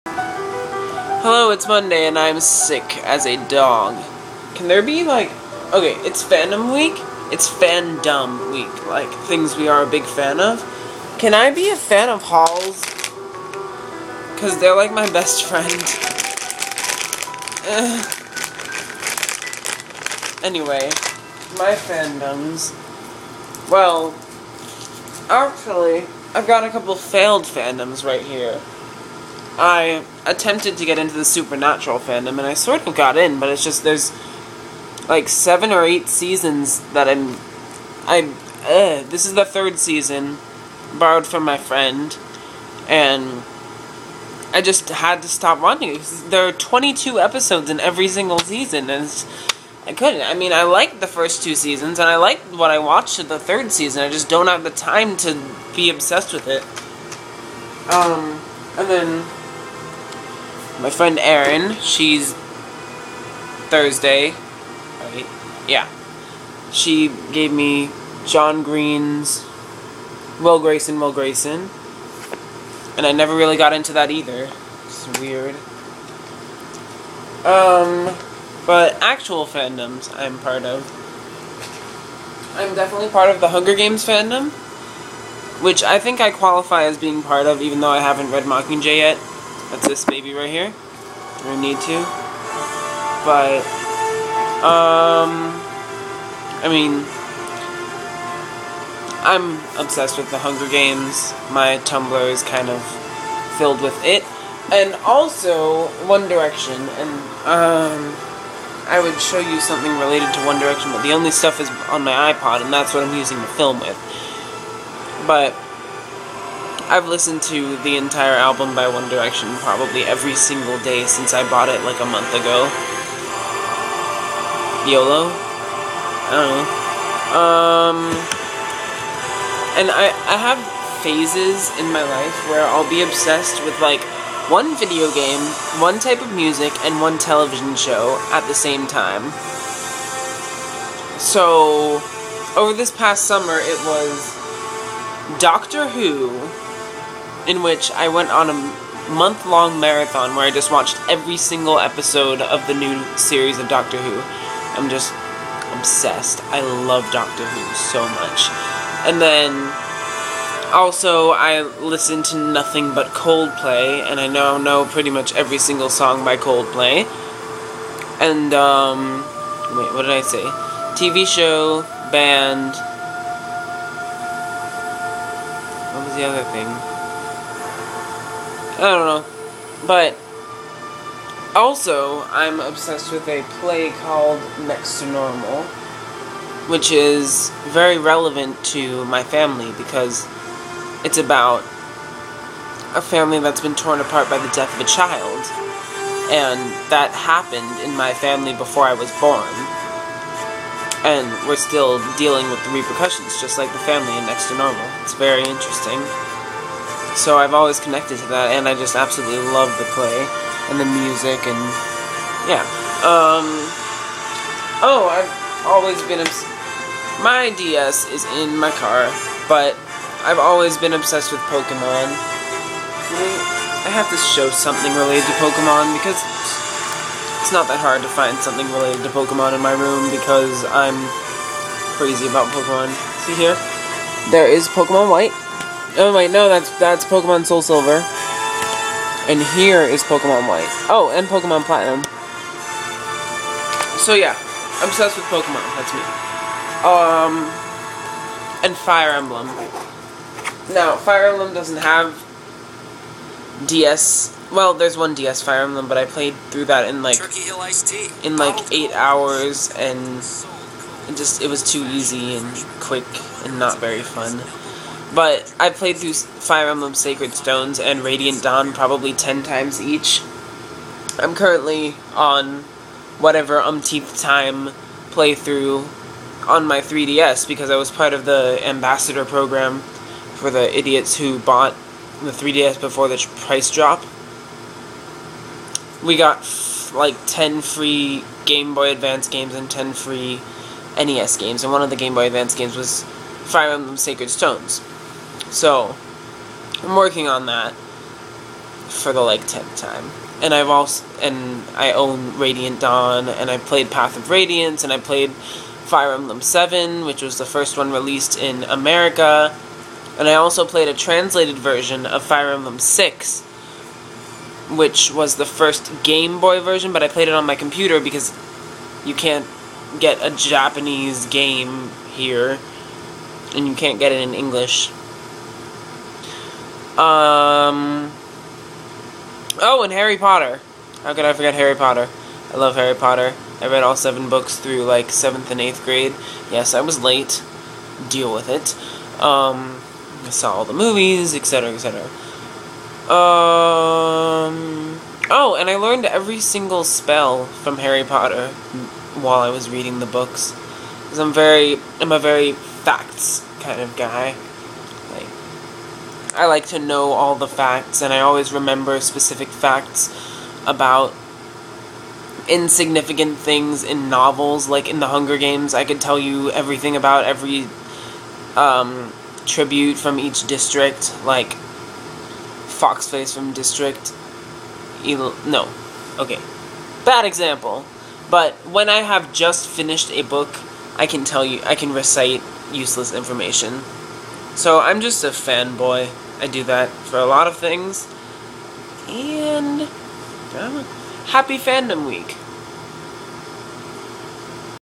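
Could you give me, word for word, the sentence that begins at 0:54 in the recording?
I just don't have the time to be obsessed with it.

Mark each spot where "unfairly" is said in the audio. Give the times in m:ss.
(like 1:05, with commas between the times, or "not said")
not said.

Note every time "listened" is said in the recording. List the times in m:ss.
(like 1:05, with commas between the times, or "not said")
1:57, 2:41.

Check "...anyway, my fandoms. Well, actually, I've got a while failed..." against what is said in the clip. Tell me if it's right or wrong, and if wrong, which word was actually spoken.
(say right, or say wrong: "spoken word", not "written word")
wrong: "couple", not "while".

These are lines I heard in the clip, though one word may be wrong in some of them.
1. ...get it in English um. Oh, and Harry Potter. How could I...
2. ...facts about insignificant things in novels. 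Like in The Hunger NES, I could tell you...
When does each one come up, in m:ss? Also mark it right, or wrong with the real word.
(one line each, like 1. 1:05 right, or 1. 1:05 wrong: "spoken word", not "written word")
1. 5:23 right
2. 5:59 wrong: "Games", not "NES".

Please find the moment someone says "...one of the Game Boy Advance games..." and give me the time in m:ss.
4:51.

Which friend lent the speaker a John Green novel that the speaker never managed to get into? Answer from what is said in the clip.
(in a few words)
Erin.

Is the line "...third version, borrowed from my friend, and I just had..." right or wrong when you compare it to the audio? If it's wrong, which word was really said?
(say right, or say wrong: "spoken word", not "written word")
wrong: "season", not "version".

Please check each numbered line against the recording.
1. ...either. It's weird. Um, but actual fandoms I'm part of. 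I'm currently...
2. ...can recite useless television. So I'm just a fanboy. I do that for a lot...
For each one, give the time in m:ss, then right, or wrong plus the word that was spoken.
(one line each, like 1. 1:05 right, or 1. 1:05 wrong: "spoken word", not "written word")
1. 1:14 wrong: "definitely", not "currently"
2. 6:21 wrong: "information", not "television".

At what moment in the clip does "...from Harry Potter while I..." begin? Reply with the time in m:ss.
5:47.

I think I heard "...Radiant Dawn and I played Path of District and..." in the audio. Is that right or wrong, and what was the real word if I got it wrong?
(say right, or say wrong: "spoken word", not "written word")
wrong: "Radiance", not "District".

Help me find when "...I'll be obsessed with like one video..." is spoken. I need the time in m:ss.
2:12.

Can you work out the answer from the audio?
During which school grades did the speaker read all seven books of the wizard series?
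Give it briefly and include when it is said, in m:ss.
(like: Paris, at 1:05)
seventh and eighth, at 5:35.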